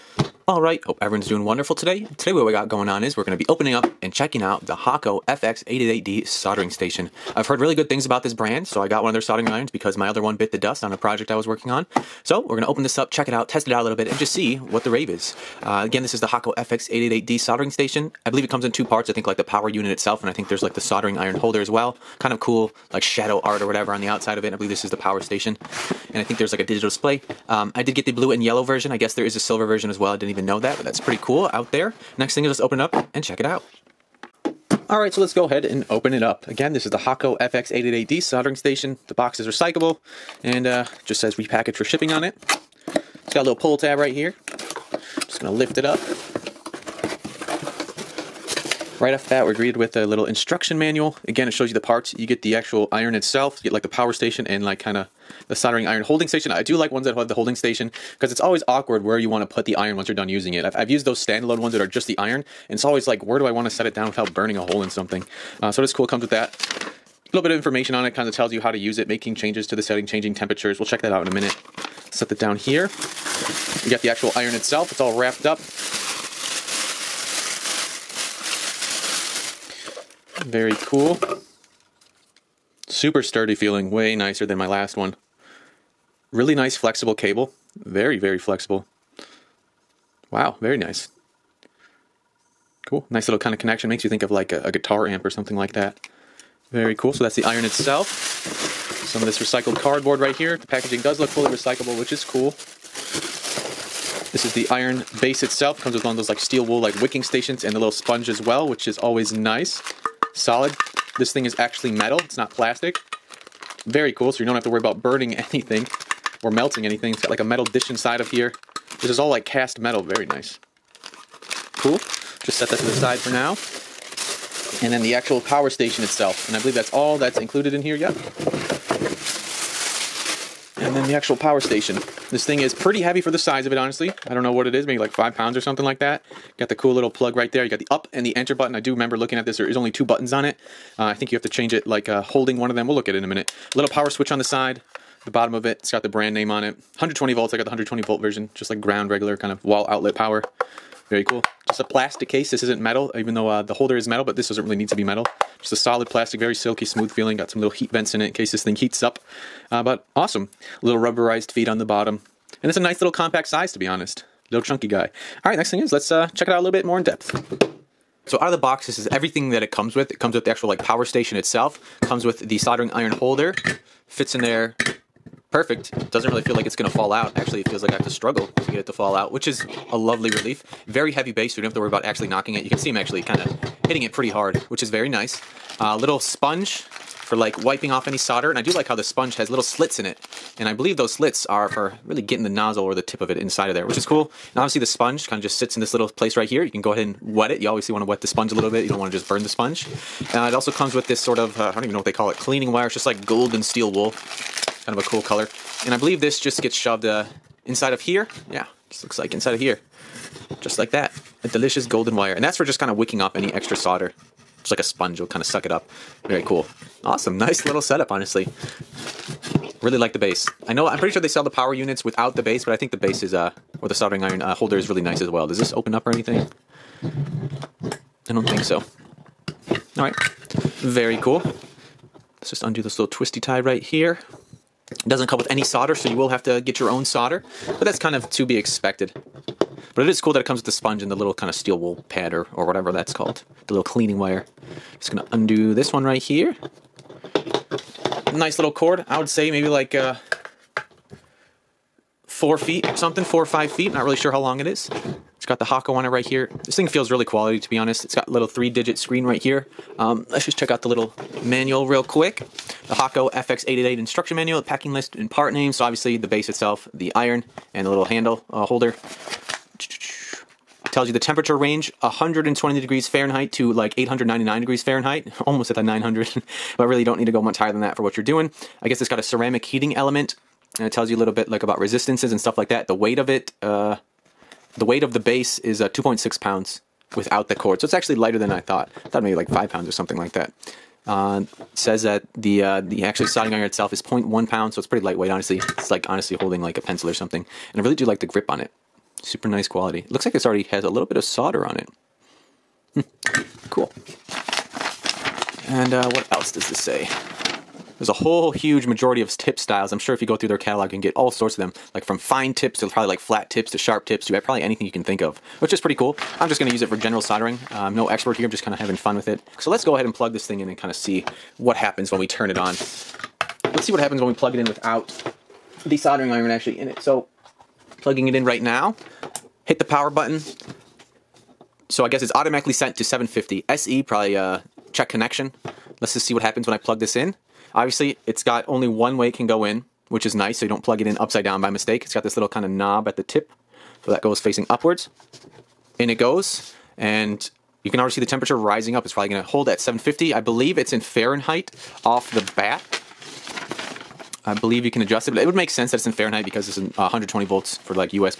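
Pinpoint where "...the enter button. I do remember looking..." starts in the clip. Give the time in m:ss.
2:18.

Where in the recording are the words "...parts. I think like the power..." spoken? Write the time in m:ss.
0:18.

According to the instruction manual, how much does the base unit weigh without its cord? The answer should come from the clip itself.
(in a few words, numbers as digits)
2.6 pounds.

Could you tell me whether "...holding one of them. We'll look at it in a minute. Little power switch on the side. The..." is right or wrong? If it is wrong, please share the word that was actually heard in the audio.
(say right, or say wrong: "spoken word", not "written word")
right.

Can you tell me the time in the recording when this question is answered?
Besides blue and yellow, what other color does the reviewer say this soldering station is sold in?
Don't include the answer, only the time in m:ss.
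0:29.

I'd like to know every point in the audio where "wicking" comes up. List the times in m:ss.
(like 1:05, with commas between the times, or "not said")
1:47, 3:32.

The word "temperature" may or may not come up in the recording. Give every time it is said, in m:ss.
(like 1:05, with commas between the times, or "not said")
1:10, 4:31, 5:48.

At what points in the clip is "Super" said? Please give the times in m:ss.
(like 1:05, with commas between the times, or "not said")
1:22, 4:59.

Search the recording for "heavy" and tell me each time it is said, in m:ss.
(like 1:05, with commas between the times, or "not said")
2:13, 3:01.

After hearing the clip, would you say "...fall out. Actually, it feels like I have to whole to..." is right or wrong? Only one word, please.
wrong.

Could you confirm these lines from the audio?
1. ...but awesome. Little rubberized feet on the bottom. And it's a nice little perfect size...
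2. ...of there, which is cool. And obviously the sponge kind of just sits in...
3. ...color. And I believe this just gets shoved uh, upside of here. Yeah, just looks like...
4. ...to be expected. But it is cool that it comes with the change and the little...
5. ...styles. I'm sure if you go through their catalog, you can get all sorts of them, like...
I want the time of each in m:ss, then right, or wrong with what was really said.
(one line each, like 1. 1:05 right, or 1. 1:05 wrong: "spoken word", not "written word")
1. 2:39 wrong: "compact", not "perfect"
2. 3:13 right
3. 3:25 wrong: "inside", not "upside"
4. 3:58 wrong: "sponge", not "change"
5. 5:09 right.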